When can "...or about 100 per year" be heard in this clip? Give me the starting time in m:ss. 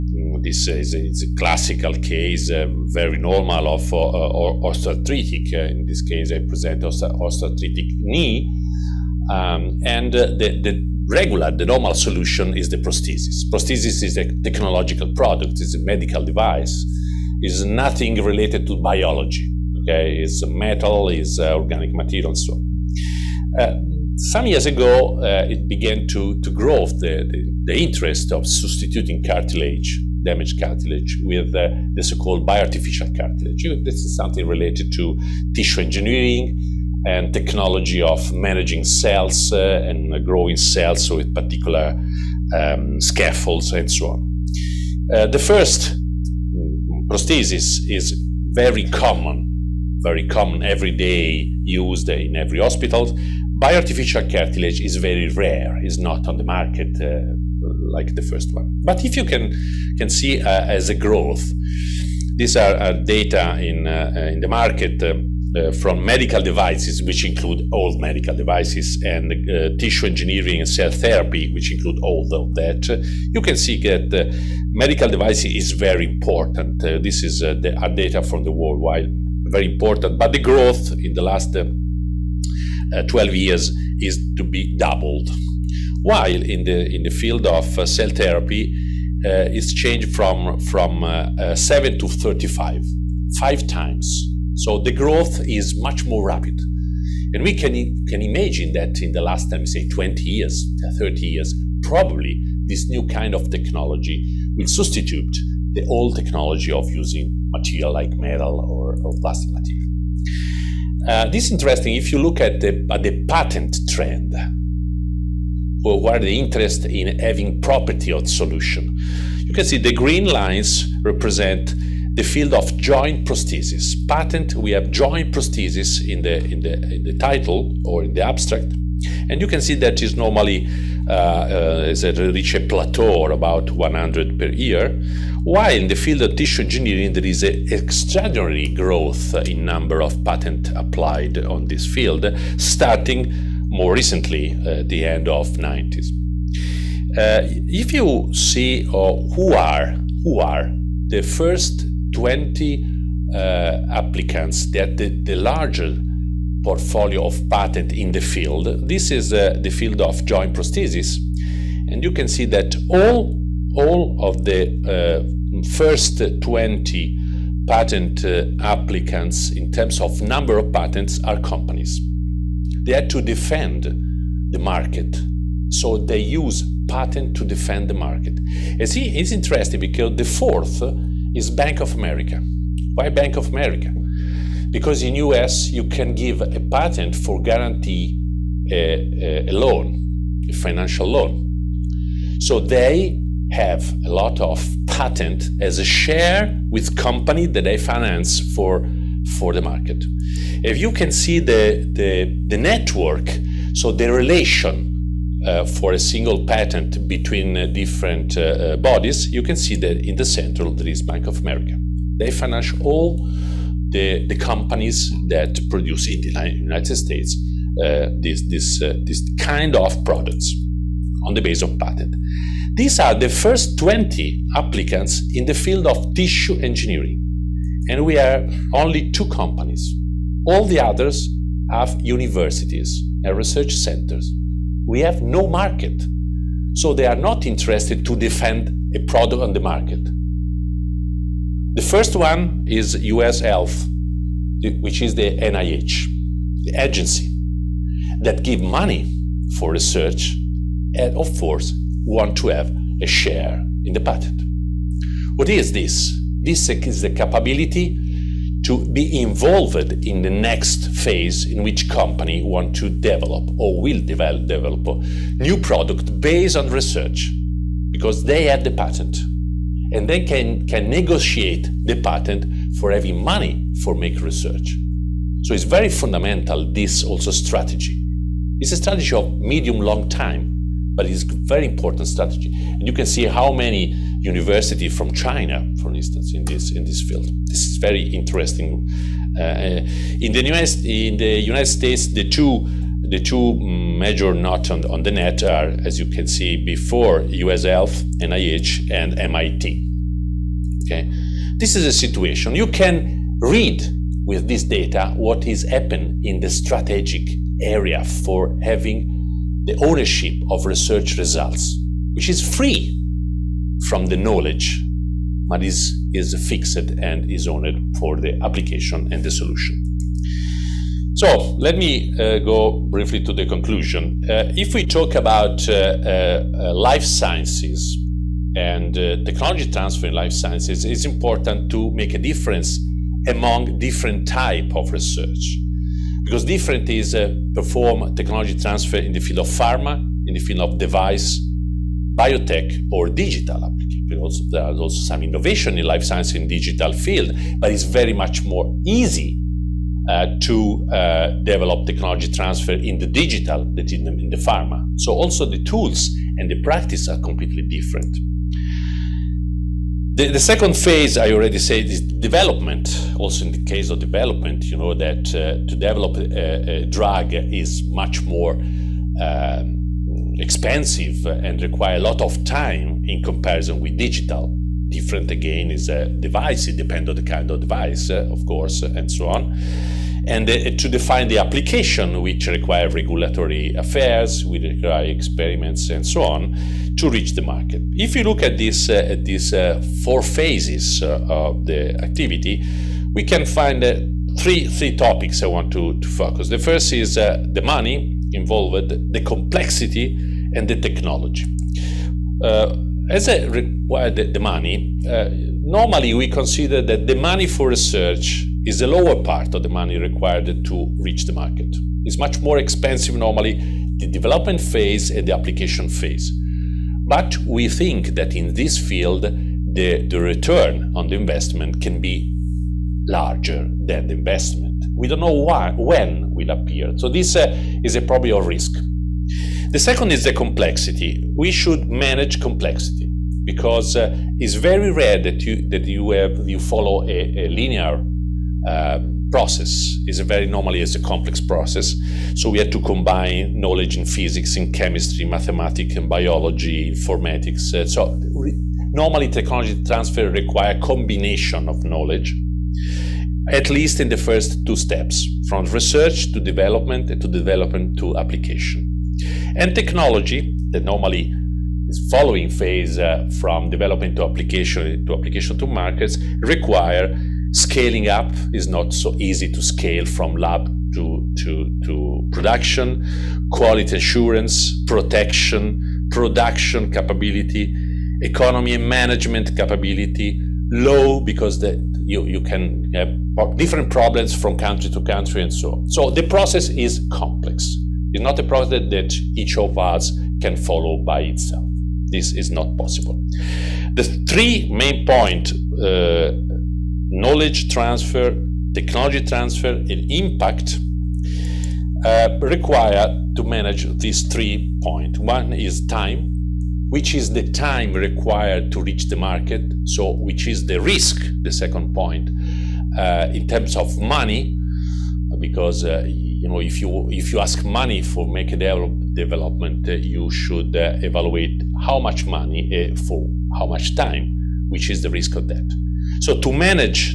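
2:13.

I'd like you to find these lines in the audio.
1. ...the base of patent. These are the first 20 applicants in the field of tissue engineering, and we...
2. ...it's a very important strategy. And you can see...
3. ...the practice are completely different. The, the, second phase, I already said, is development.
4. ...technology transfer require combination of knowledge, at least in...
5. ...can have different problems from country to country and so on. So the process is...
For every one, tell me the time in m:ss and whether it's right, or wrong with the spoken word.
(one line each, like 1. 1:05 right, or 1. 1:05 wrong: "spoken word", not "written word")
1. 3:41 right
2. 4:41 right
3. 5:56 right
4. 7:29 right
5. 8:02 right.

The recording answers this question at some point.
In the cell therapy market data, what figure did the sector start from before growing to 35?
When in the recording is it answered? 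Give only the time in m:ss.
1:31.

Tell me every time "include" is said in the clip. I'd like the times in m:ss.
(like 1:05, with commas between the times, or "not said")
1:07, 1:11.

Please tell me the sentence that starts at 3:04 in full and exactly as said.
Because in US you can give a patent for guarantee a, uh, uh, a loan, a financial loan.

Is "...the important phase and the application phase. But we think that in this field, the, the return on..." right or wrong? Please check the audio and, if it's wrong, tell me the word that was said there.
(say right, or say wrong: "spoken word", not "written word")
wrong: "development", not "important".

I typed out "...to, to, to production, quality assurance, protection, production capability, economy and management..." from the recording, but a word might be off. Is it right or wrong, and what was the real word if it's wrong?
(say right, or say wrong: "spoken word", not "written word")
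right.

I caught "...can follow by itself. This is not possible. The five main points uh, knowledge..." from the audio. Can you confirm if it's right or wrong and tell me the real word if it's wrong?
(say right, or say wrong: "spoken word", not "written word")
wrong: "three", not "five".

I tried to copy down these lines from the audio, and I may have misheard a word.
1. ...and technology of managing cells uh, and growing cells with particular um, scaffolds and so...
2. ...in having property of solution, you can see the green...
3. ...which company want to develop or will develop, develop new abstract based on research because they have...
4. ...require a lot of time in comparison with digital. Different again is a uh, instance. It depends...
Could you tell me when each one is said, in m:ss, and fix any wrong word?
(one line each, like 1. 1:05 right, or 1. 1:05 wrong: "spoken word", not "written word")
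1. 0:37 right
2. 1:56 right
3. 4:21 wrong: "product", not "abstract"
4. 6:11 wrong: "device", not "instance".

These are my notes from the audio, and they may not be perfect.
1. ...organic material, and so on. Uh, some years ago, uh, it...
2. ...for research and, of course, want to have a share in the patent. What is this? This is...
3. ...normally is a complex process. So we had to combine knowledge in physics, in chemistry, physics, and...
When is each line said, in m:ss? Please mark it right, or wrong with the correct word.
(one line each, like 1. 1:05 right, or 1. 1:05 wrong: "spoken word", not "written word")
1. 0:21 right
2. 4:09 right
3. 7:20 wrong: "mathematics", not "physics".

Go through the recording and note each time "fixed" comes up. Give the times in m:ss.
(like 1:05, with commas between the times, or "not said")
5:16.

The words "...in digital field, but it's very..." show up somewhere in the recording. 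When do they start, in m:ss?
5:46.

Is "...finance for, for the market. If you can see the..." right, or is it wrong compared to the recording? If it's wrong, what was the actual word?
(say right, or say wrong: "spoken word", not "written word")
right.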